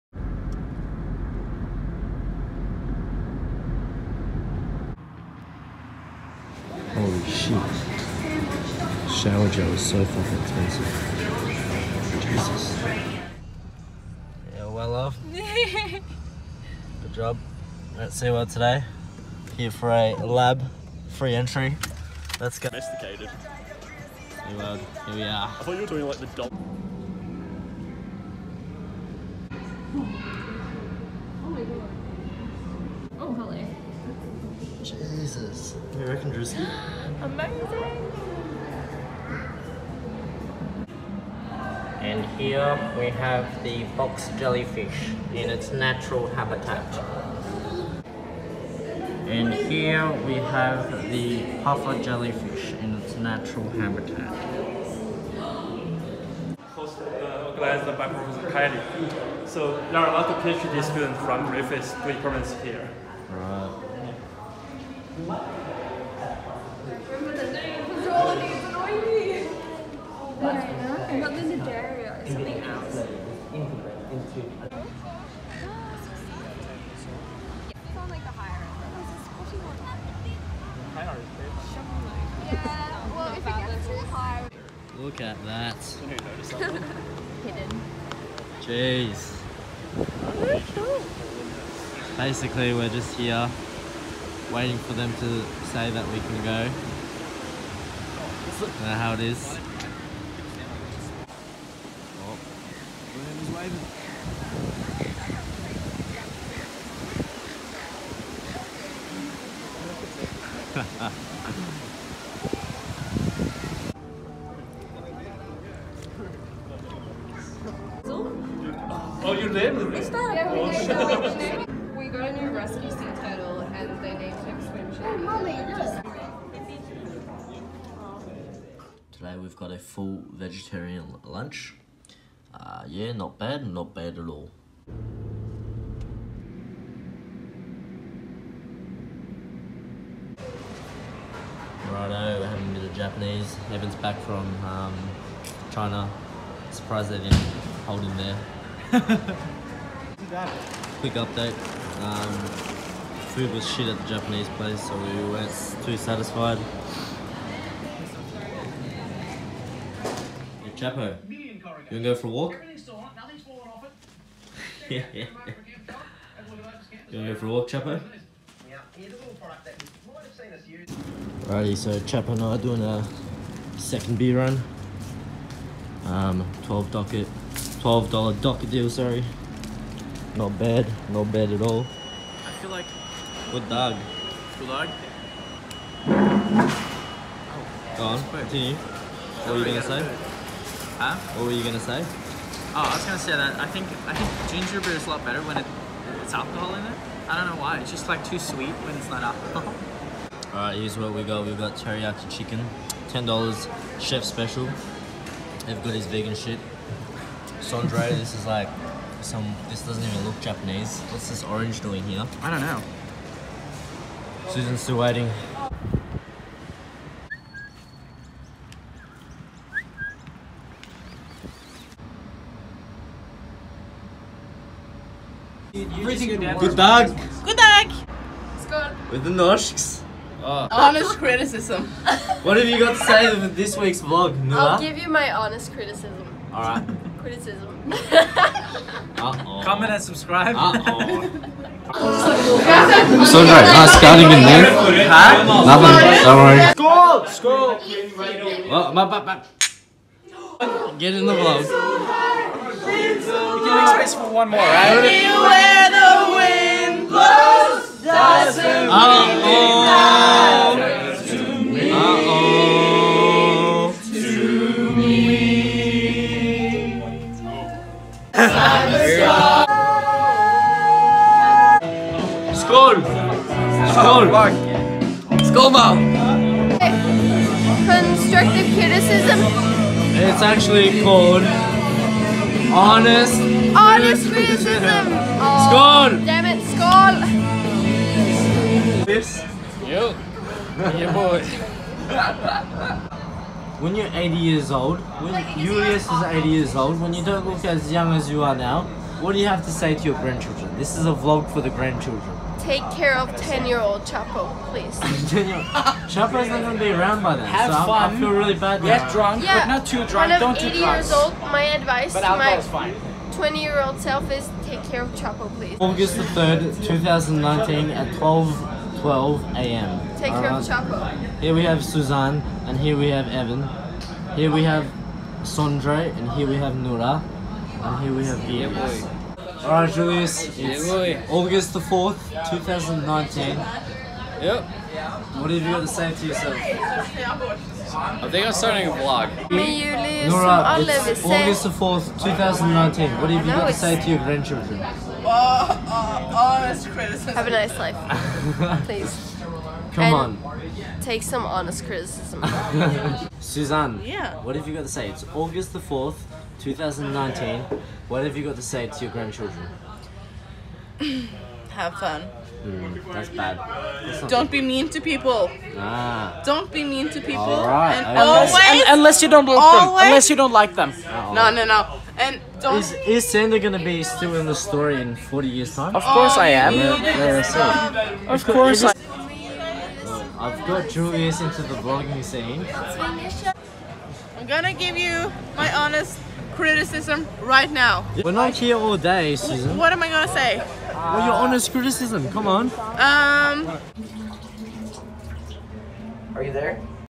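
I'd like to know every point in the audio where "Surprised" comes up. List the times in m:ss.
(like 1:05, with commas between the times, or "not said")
2:26.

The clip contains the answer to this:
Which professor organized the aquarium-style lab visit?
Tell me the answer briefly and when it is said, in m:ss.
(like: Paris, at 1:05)
Professor Kylie, at 0:58.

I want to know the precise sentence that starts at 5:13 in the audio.
20 year old self is take care of Chapo, please.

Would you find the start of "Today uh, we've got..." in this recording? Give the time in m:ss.
2:09.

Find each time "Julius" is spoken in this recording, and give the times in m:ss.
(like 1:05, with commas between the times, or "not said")
4:55, 5:29, 5:39, 6:20.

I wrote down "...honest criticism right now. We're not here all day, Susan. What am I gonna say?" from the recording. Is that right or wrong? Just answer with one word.
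right.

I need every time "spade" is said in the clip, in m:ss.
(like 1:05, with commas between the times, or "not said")
not said.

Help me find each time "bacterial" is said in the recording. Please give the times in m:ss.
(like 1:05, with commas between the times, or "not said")
not said.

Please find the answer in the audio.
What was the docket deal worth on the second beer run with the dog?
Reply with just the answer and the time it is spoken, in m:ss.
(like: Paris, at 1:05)
$12, at 2:57.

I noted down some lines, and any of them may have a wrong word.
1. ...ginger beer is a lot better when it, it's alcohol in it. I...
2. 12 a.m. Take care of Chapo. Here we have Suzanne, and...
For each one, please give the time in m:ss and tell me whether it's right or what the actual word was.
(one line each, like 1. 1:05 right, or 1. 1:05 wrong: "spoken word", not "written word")
1. 3:14 right
2. 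5:19 right.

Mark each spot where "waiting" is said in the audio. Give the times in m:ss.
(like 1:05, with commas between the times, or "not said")
1:34, 3:34.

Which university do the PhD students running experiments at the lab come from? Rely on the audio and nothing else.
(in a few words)
Griffith.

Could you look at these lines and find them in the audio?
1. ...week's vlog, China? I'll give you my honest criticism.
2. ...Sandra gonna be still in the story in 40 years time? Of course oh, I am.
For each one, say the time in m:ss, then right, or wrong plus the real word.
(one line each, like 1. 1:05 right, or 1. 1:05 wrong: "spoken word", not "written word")
1. 3:53 wrong: "Nula", not "China"
2. 6:13 right.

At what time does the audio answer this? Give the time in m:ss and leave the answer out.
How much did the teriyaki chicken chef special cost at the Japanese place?
3:23.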